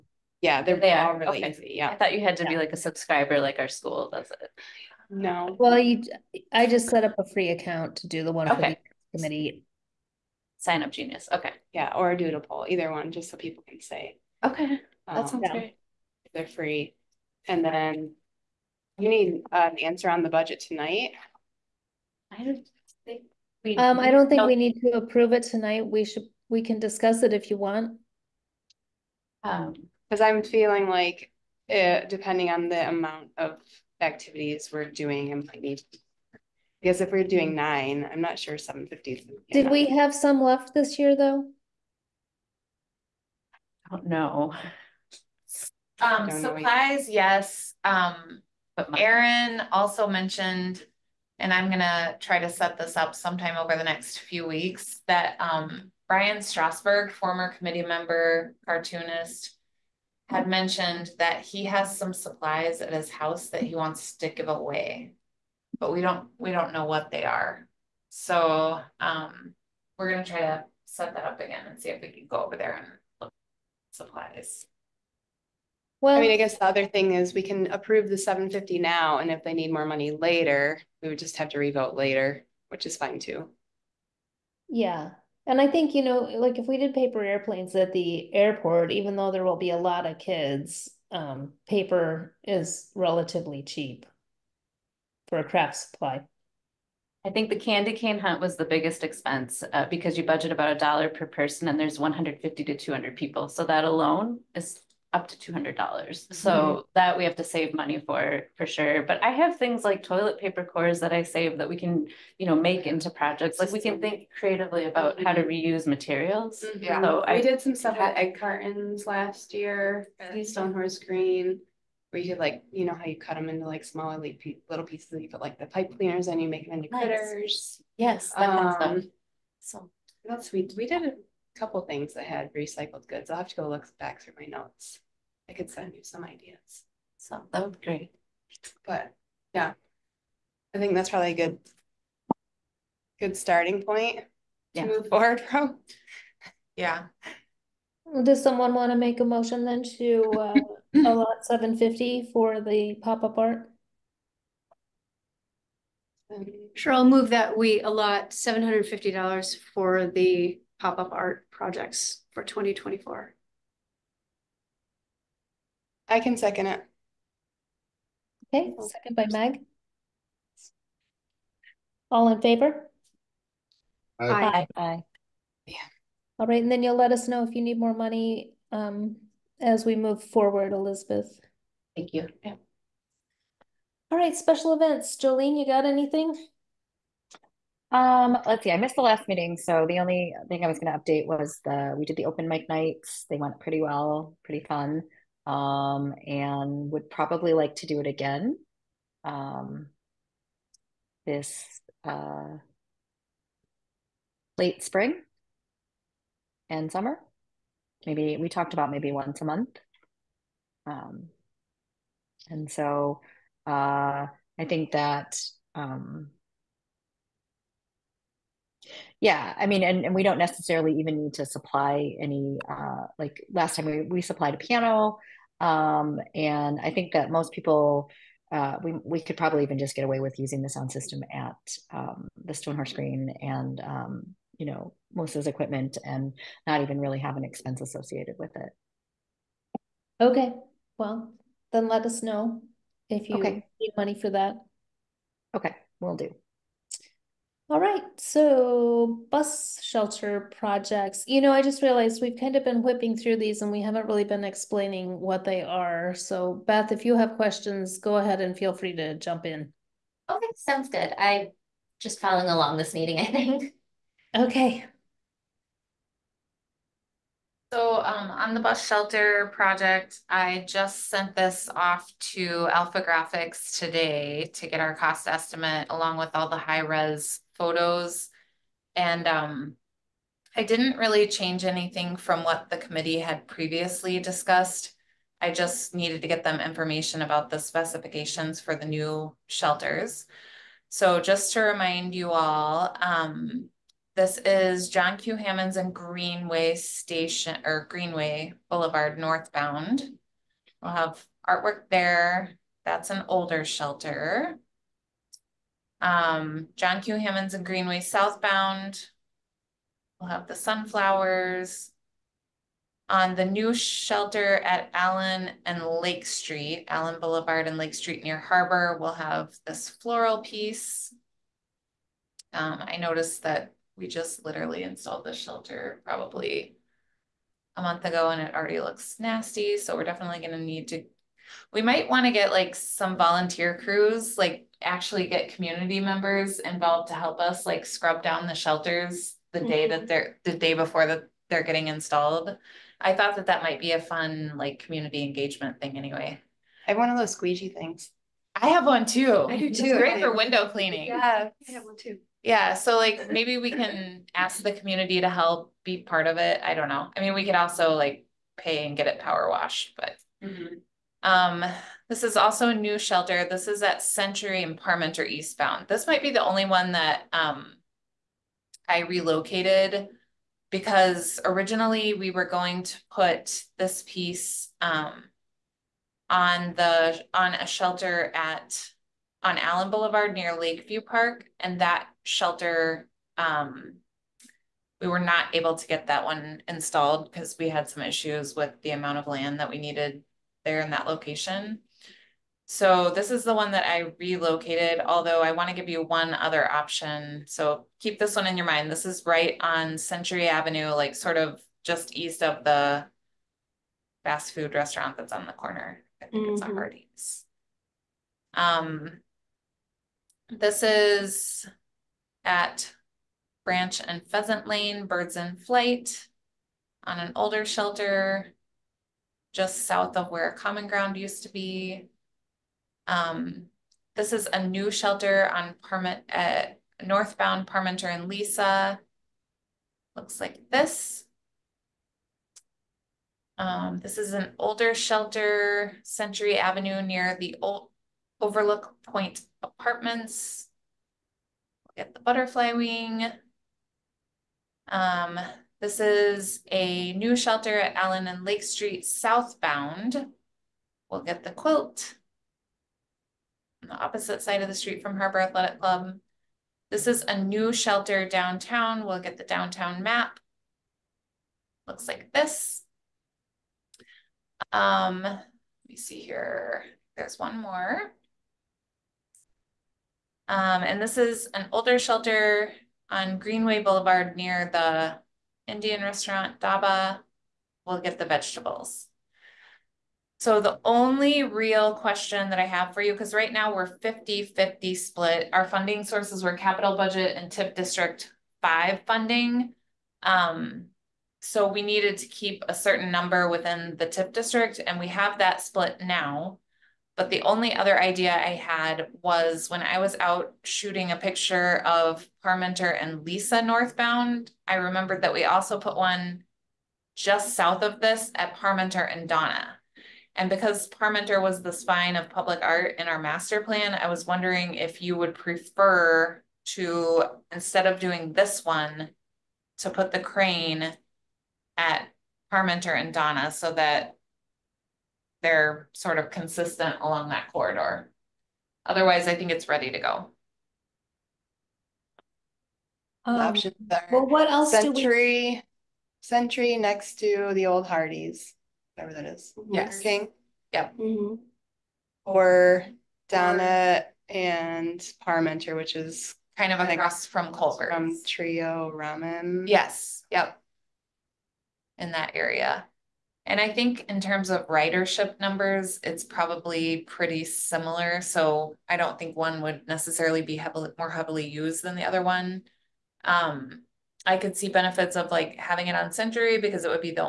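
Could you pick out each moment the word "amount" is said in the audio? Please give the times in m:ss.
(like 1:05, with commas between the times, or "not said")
0:32, 6:28.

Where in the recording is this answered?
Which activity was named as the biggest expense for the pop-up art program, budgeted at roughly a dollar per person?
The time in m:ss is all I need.
1:37.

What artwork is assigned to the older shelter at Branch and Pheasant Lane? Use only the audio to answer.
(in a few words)
Birds in Flight.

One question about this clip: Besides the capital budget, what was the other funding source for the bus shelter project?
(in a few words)
TIF District 5.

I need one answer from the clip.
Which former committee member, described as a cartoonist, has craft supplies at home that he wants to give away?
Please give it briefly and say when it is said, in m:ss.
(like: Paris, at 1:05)
Brian Strasberg, at 0:56.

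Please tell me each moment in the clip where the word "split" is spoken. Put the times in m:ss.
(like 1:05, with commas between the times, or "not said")
8:04, 8:15.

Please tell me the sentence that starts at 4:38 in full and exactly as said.
And um, I didn't really change anything from what the committee had previously discussed.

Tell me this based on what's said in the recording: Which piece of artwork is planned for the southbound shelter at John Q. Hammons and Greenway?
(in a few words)
sunflowers.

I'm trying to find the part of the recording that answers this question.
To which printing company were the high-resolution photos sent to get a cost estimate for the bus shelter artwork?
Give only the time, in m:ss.
4:32.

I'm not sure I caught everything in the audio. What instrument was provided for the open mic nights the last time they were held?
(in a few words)
piano.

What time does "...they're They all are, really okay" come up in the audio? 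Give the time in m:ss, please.
0:00.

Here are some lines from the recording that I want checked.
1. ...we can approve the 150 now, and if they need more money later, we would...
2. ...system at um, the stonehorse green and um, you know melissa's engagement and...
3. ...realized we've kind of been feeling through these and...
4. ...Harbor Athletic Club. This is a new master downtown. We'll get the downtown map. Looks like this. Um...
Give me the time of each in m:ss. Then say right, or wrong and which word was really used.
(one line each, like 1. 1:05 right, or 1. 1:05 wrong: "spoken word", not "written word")
1. 1:17 wrong: "750", not "150"
2. 3:50 wrong: "equipment", not "engagement"
3. 4:11 wrong: "whipping", not "feeling"
4. 7:35 wrong: "shelter", not "master".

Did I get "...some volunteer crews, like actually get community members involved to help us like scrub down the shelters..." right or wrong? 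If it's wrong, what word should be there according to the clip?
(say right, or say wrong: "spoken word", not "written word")
right.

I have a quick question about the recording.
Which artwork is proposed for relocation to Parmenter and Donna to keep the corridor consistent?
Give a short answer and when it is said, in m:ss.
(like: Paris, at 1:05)
the crane, at 8:40.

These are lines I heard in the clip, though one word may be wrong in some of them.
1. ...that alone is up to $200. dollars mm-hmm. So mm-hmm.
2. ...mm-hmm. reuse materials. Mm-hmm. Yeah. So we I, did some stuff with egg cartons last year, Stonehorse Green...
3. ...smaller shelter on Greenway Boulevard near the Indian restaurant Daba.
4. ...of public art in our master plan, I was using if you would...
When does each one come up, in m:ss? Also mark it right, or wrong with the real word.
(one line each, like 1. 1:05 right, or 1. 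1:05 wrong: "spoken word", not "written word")
1. 1:43 right
2. 1:55 right
3. 7:51 wrong: "older", not "smaller"
4. 8:32 wrong: "wondering", not "using".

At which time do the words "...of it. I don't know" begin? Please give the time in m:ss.
5:56.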